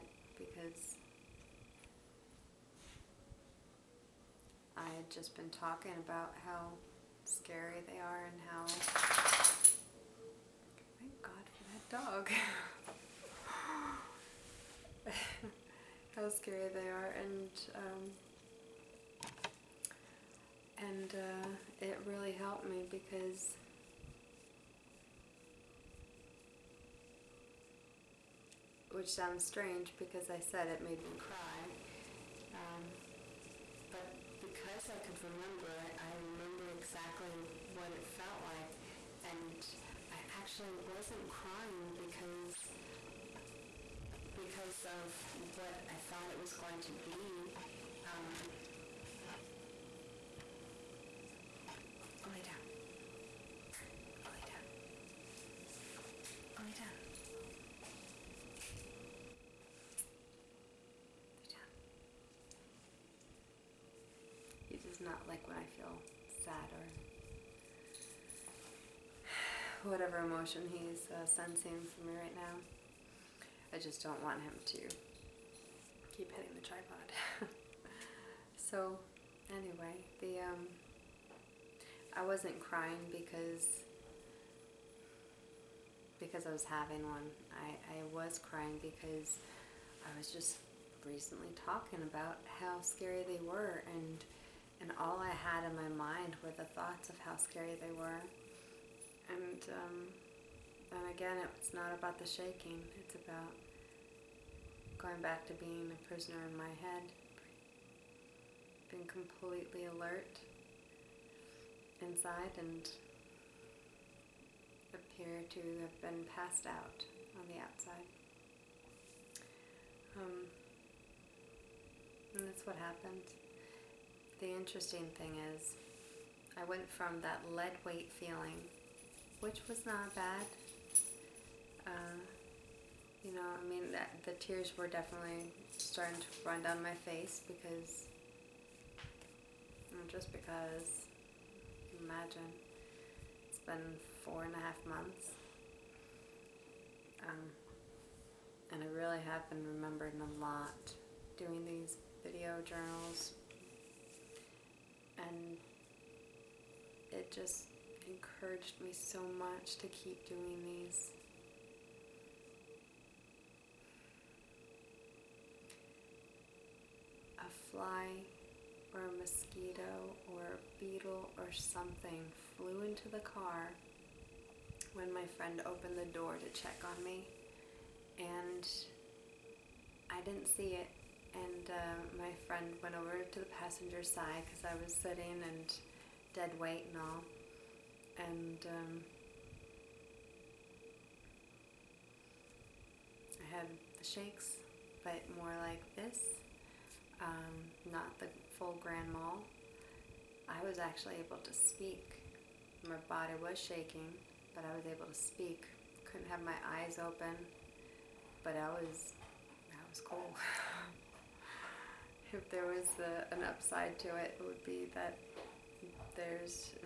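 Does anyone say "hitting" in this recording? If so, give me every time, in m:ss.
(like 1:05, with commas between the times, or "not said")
1:16.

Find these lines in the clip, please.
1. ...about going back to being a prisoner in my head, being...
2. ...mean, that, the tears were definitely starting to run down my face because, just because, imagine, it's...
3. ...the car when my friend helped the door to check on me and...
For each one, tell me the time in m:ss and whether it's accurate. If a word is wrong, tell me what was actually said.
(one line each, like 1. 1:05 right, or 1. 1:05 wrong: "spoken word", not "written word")
1. 1:43 right
2. 2:13 right
3. 2:53 wrong: "opened", not "helped".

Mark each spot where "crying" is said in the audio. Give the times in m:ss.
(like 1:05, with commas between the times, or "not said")
0:41, 1:22, 1:28.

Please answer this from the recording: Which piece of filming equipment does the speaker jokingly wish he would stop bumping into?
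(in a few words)
tripod.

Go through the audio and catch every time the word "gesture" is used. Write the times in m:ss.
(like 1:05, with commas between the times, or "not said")
not said.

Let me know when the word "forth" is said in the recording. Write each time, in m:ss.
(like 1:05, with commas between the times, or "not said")
not said.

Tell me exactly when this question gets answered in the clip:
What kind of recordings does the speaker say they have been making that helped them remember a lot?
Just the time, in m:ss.
2:32.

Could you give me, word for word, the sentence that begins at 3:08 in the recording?
And um, I had the shakes, but more like this, um, not the full grand mal.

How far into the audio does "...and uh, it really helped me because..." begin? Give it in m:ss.
0:20.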